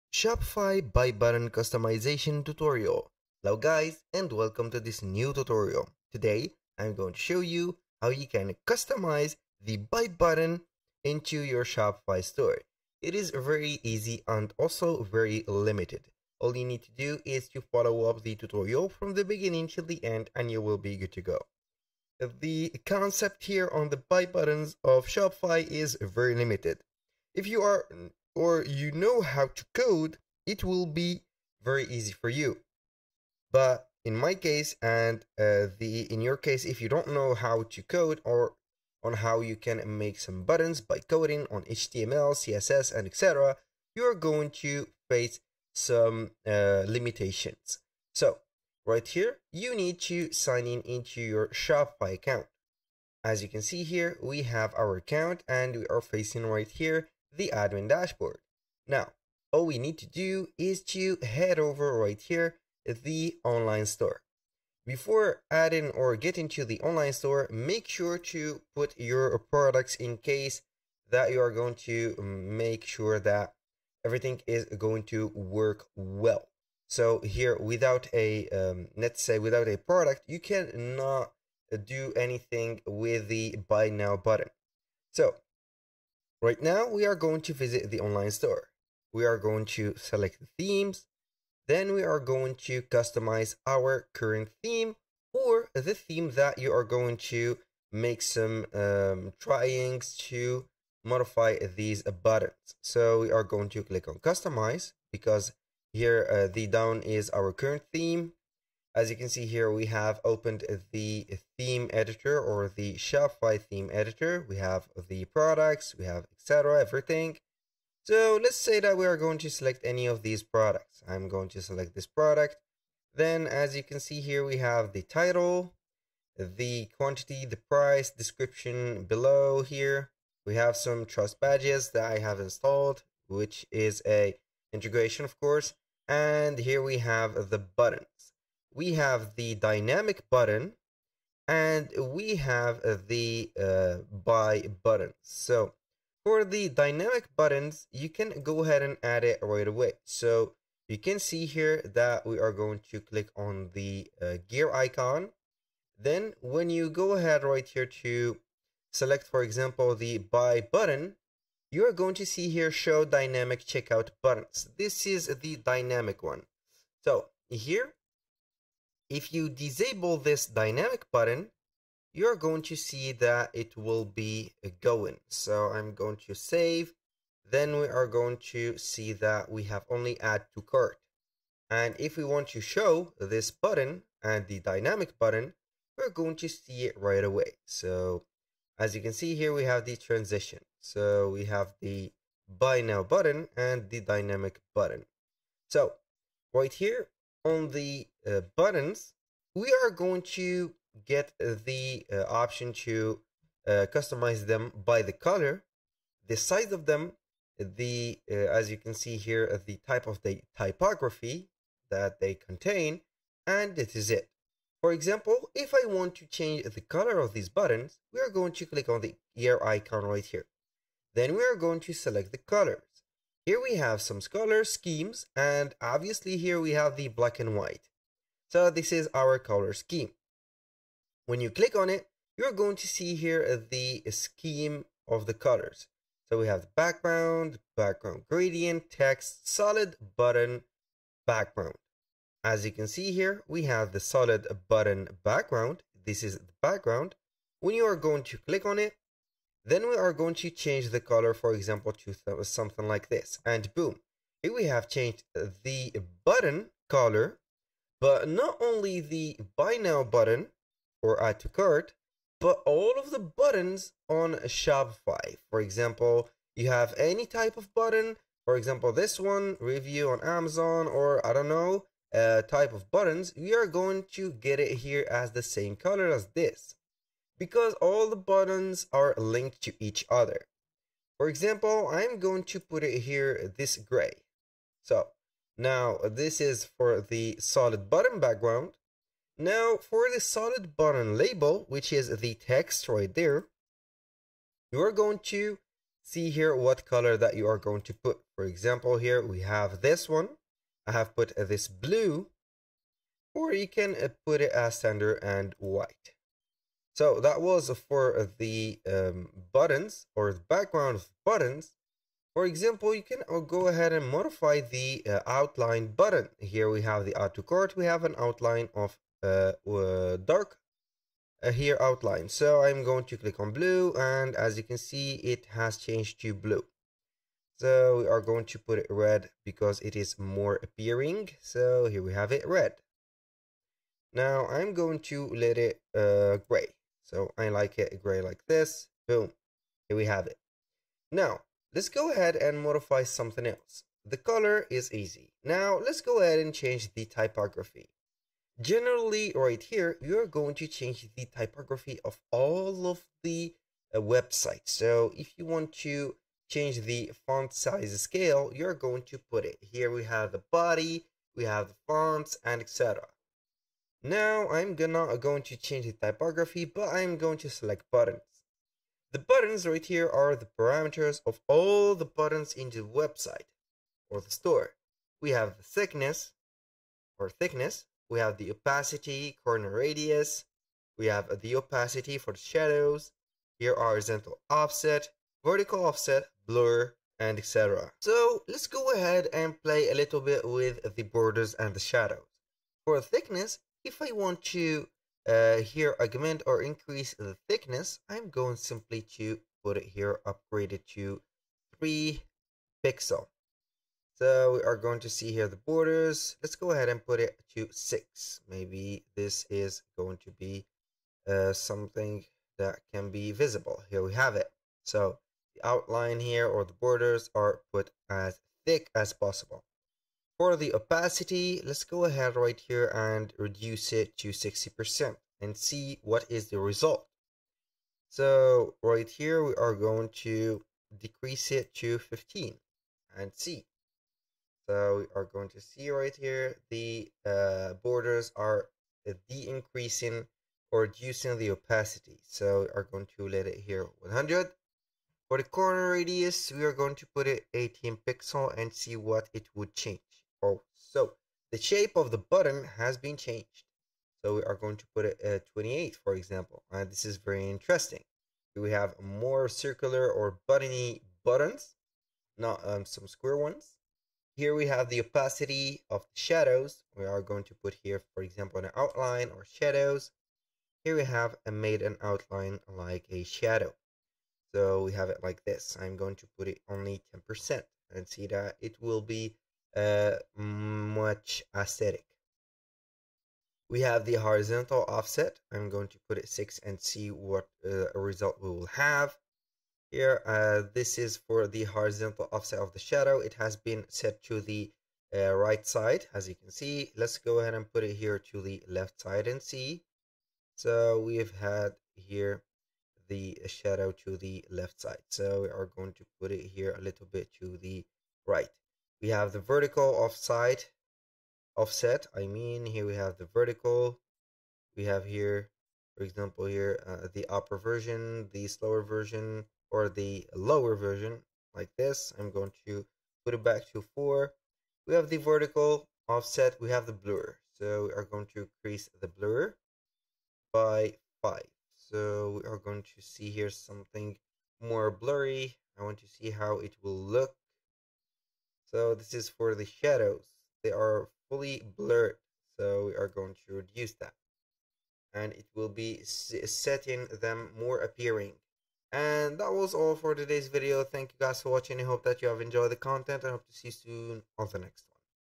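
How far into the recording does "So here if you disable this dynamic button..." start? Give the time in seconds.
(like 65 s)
167 s.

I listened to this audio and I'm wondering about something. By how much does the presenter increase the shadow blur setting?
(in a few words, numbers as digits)
5.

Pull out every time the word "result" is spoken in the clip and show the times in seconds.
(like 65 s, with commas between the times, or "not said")
426 s, 487 s.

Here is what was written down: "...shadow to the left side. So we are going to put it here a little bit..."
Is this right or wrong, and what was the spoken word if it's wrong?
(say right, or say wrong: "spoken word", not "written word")
right.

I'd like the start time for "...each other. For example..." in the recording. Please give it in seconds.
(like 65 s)
279 s.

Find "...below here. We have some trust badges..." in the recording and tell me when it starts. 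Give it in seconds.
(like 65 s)
129 s.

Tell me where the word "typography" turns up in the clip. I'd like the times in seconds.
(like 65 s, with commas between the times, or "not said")
210 s, 347 s, 351 s, 365 s.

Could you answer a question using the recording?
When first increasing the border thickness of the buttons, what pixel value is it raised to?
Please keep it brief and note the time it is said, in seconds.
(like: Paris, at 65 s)
3 pixels, at 401 s.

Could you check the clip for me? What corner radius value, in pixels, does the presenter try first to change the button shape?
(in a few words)
18 pixels.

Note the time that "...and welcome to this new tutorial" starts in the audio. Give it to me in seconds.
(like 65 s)
4 s.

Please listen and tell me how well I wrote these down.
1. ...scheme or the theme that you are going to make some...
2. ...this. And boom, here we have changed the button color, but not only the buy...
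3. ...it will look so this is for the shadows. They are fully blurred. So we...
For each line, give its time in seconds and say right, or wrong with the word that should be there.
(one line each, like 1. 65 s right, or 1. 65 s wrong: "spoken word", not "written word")
1. 94 s wrong: "theme", not "scheme"
2. 253 s right
3. 536 s right.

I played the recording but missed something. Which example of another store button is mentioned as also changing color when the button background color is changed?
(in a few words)
Review on Amazon.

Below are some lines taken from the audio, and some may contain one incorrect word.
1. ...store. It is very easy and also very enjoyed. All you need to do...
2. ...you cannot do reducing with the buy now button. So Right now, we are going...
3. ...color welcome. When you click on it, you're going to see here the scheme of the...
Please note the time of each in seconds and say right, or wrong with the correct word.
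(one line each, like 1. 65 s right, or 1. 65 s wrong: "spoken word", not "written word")
1. 12 s wrong: "limited", not "enjoyed"
2. 80 s wrong: "anything", not "reducing"
3. 229 s wrong: "scheme", not "welcome".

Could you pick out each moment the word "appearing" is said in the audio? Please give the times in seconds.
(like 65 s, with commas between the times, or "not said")
330 s, 547 s.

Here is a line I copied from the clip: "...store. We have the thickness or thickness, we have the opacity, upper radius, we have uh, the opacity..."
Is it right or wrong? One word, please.
wrong.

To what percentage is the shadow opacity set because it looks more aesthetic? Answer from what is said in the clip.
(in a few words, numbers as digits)
10%.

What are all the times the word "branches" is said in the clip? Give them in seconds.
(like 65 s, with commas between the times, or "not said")
not said.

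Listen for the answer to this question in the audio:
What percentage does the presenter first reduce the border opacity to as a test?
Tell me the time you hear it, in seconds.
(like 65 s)
424 s.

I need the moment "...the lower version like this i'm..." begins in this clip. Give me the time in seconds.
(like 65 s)
519 s.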